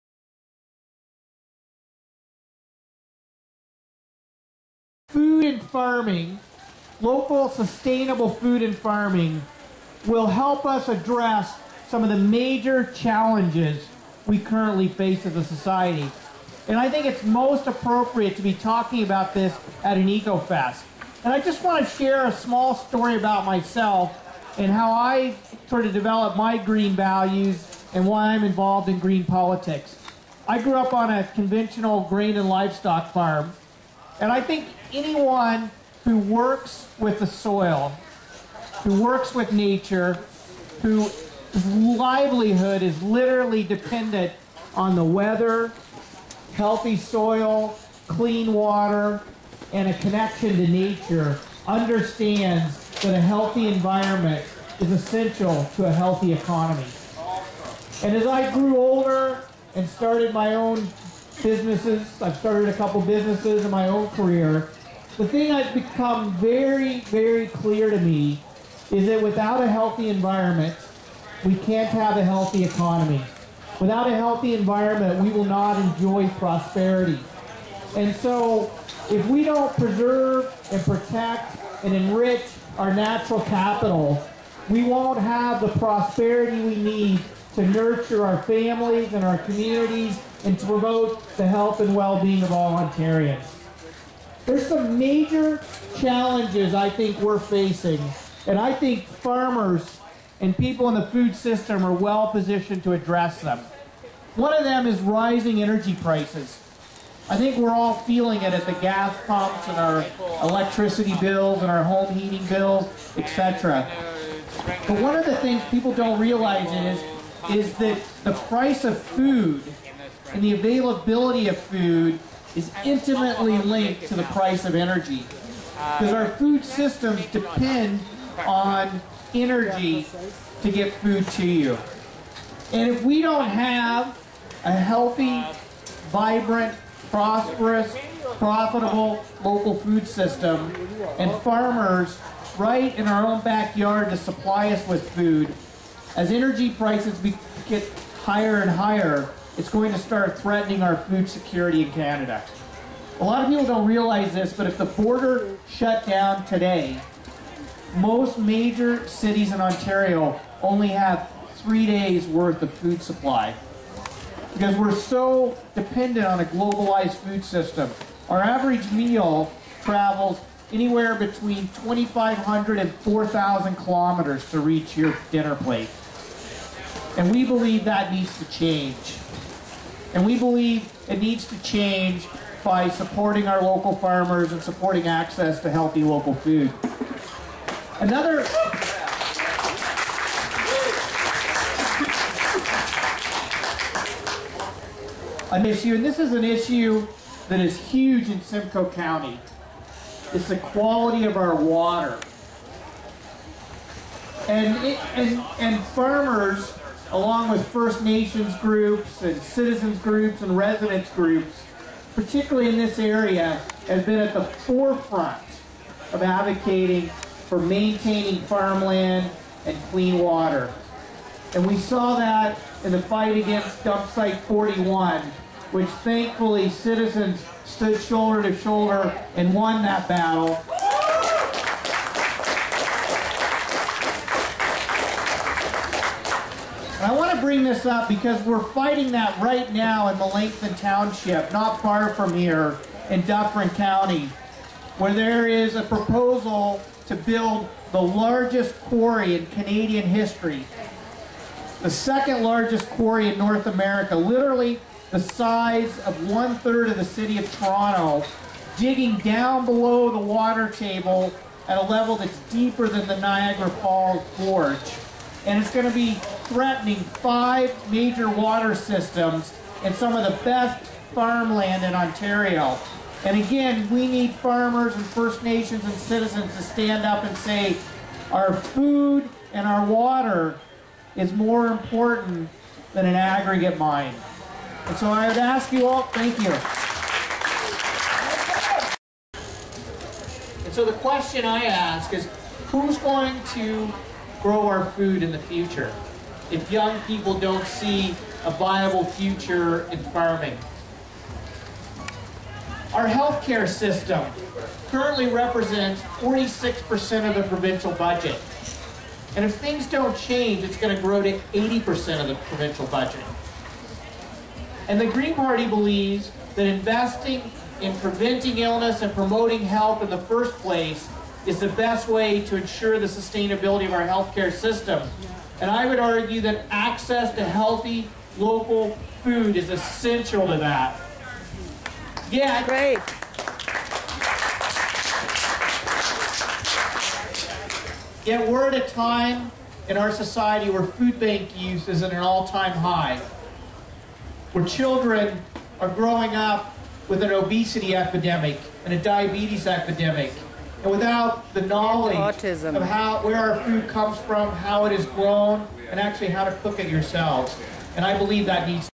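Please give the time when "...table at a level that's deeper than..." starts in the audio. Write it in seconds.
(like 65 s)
260 s.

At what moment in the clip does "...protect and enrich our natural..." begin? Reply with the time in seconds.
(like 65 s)
80 s.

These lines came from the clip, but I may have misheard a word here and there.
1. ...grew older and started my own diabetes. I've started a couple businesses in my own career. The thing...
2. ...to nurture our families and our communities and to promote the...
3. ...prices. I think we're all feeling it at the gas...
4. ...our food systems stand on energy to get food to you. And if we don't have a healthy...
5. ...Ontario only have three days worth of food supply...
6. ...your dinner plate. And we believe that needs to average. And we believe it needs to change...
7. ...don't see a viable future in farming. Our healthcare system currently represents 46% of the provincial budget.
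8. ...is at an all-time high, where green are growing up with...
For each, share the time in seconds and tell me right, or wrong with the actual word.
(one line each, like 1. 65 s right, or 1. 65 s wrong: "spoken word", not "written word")
1. 58 s wrong: "businesses", not "diabetes"
2. 87 s right
3. 106 s right
4. 126 s wrong: "depend", not "stand"
5. 159 s right
6. 174 s wrong: "change", not "average"
7. 297 s right
8. 341 s wrong: "children", not "green".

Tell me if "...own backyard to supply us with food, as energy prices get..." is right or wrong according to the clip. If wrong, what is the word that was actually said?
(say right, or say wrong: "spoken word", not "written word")
right.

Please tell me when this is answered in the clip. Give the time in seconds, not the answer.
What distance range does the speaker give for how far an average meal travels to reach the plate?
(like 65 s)
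171 s.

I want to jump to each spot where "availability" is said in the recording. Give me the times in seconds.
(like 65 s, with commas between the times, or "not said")
120 s.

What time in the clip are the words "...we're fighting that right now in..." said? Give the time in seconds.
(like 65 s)
238 s.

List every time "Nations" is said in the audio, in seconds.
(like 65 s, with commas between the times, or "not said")
208 s, 275 s.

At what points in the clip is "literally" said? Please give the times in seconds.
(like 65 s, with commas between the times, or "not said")
43 s, 254 s.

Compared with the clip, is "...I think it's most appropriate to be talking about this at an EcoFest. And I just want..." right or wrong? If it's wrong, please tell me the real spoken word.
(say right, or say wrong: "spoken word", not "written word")
right.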